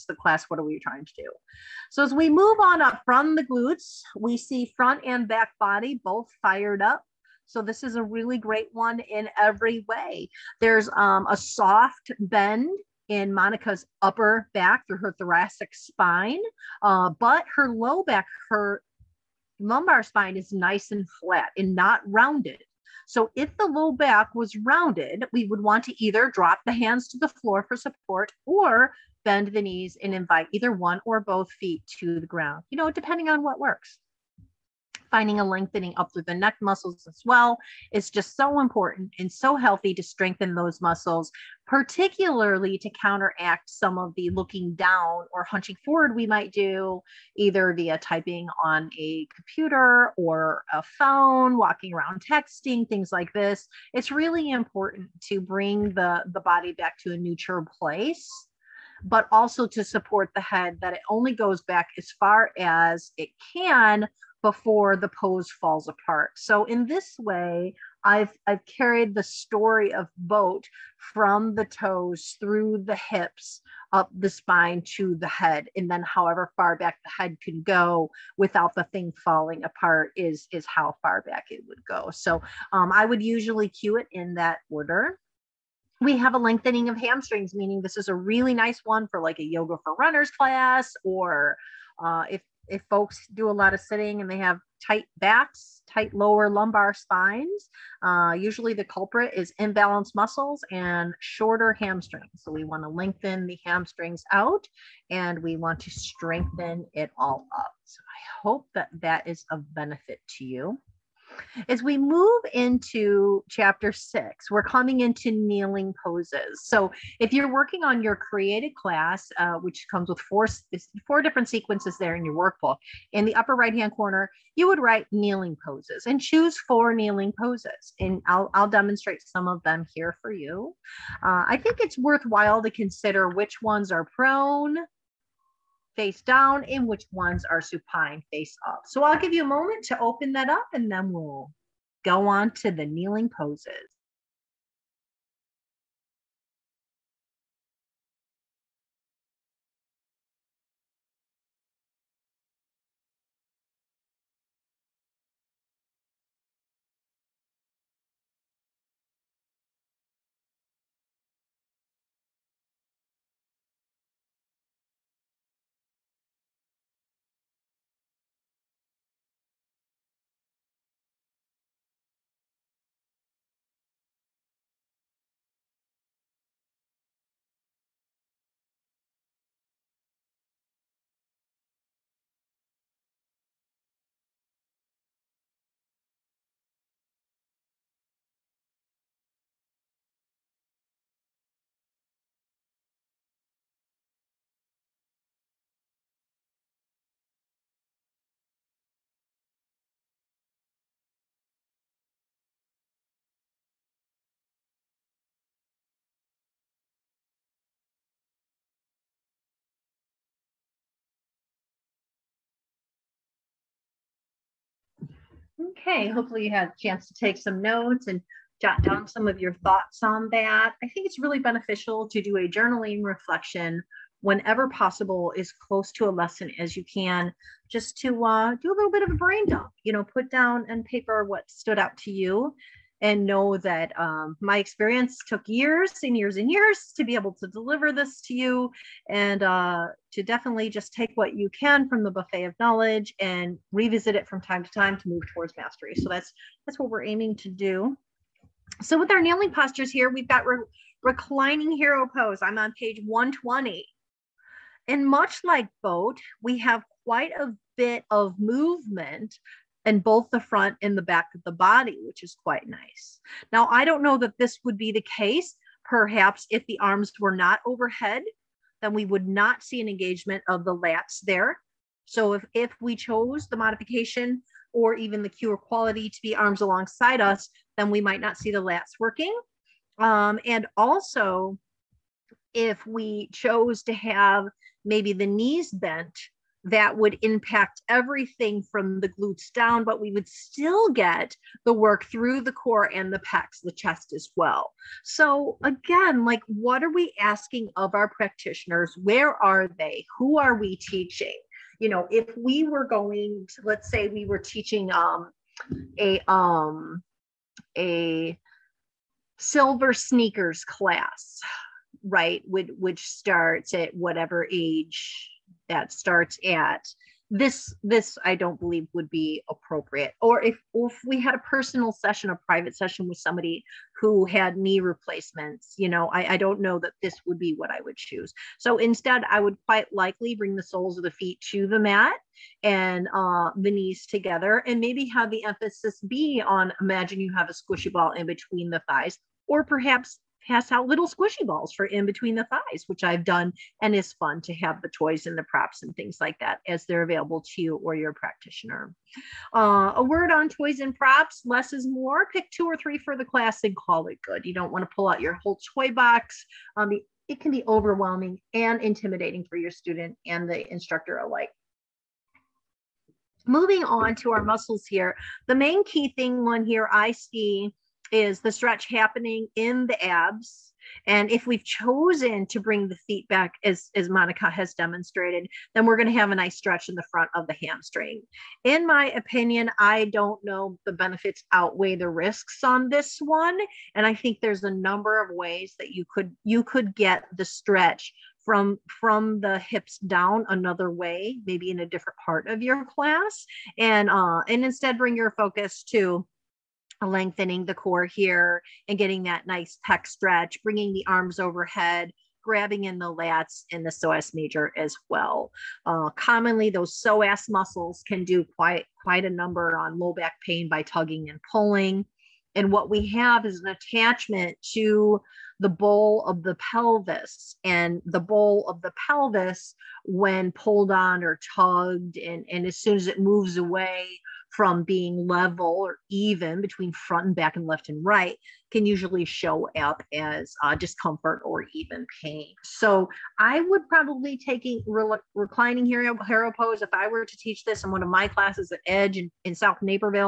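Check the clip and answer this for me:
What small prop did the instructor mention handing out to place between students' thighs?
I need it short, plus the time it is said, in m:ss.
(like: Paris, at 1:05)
squishy balls, at 5:41.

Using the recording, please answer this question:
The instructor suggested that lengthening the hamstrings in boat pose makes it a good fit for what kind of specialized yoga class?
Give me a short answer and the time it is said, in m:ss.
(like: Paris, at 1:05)
yoga for runners, at 1:29.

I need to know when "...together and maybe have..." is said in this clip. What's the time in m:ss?
5:34.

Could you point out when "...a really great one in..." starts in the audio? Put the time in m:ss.
0:07.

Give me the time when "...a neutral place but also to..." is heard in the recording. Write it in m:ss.
0:57.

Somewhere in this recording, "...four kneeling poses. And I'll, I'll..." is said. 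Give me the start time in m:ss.
2:06.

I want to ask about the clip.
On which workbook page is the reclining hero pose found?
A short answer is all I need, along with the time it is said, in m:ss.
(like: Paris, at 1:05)
120, at 4:12.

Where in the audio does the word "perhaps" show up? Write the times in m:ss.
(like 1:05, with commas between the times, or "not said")
4:25, 5:39.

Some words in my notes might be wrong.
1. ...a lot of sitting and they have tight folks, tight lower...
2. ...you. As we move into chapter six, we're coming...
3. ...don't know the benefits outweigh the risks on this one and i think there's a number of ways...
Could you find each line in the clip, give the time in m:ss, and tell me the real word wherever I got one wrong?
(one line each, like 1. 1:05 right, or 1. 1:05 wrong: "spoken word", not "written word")
1. 1:33 wrong: "backs", not "folks"
2. 1:50 right
3. 6:20 right.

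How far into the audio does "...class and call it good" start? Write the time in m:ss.
5:53.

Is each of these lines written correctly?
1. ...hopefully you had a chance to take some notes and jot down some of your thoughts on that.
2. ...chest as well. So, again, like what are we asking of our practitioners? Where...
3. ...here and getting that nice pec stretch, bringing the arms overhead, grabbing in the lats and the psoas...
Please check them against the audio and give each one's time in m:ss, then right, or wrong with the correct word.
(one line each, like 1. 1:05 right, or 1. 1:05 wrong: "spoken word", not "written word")
1. 3:36 right
2. 4:53 right
3. 6:38 right.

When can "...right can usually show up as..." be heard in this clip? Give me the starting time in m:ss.
7:08.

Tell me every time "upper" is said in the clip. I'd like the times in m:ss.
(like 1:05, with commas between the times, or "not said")
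0:14, 2:03.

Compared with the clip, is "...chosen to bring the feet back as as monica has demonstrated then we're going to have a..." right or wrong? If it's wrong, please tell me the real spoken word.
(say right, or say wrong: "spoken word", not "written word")
right.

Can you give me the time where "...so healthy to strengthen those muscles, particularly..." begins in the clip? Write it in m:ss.
0:39.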